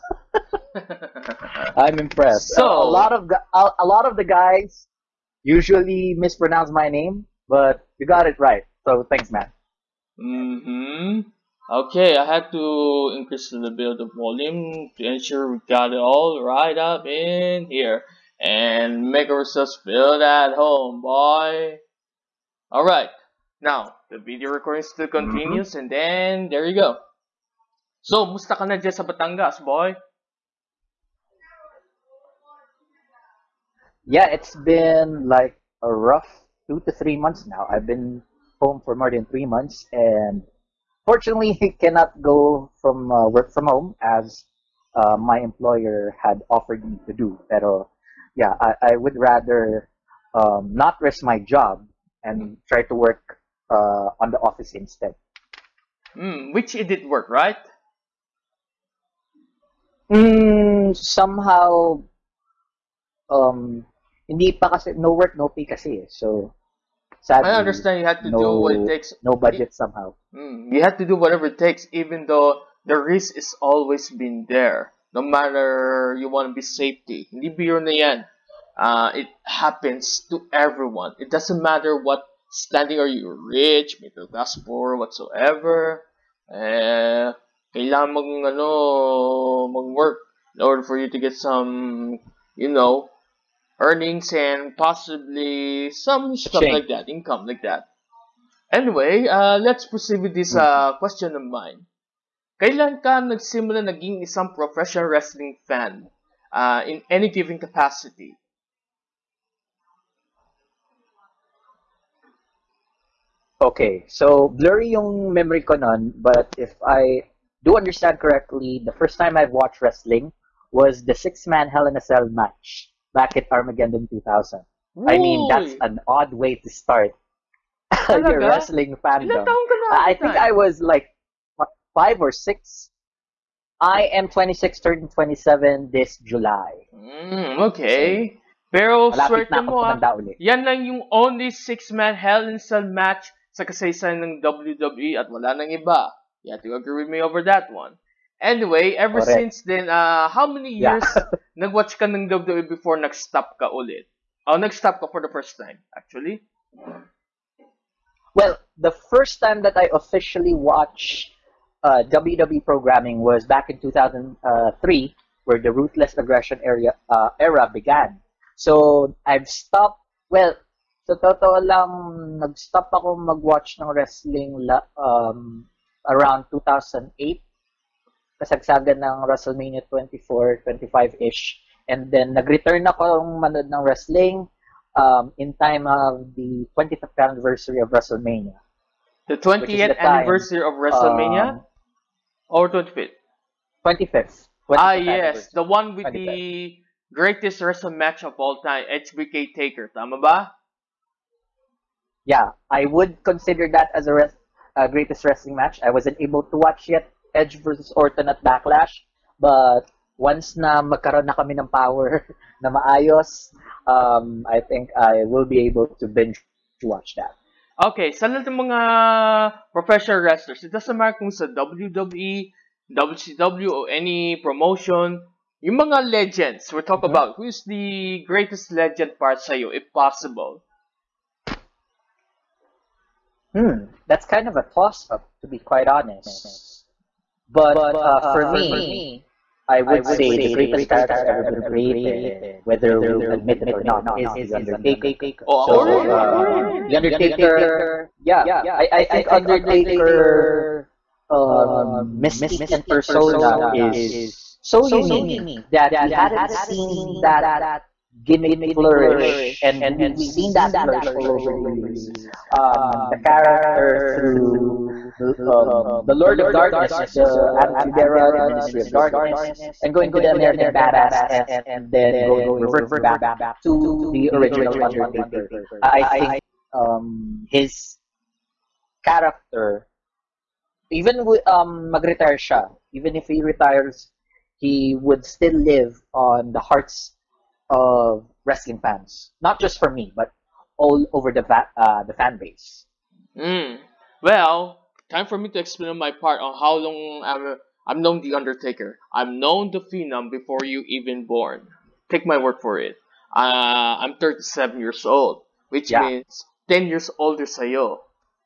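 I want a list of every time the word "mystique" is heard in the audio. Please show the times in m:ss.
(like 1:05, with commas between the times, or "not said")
4:12.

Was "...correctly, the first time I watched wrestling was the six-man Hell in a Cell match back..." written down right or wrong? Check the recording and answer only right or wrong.
right.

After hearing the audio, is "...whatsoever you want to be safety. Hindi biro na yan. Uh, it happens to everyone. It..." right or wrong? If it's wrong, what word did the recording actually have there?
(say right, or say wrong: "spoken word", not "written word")
wrong: "matter", not "whatsoever".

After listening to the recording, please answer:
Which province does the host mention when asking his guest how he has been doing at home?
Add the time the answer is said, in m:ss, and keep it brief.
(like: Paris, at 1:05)
Batangas, at 0:29.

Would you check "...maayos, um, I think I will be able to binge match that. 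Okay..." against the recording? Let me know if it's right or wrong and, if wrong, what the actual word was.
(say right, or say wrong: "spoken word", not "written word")
wrong: "watch", not "match".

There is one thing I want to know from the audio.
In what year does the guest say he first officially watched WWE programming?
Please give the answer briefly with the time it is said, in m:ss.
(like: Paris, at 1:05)
2003, at 2:43.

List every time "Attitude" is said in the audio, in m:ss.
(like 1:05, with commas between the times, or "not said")
4:27.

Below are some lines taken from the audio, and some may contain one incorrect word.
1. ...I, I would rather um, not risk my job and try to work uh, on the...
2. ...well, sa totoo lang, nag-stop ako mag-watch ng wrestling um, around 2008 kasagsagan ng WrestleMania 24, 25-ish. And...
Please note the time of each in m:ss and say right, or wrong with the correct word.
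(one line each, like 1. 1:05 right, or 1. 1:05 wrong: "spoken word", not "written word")
1. 0:48 right
2. 2:50 right.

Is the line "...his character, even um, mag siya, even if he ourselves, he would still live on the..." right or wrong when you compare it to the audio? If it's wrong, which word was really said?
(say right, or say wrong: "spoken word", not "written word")
wrong: "retires", not "ourselves".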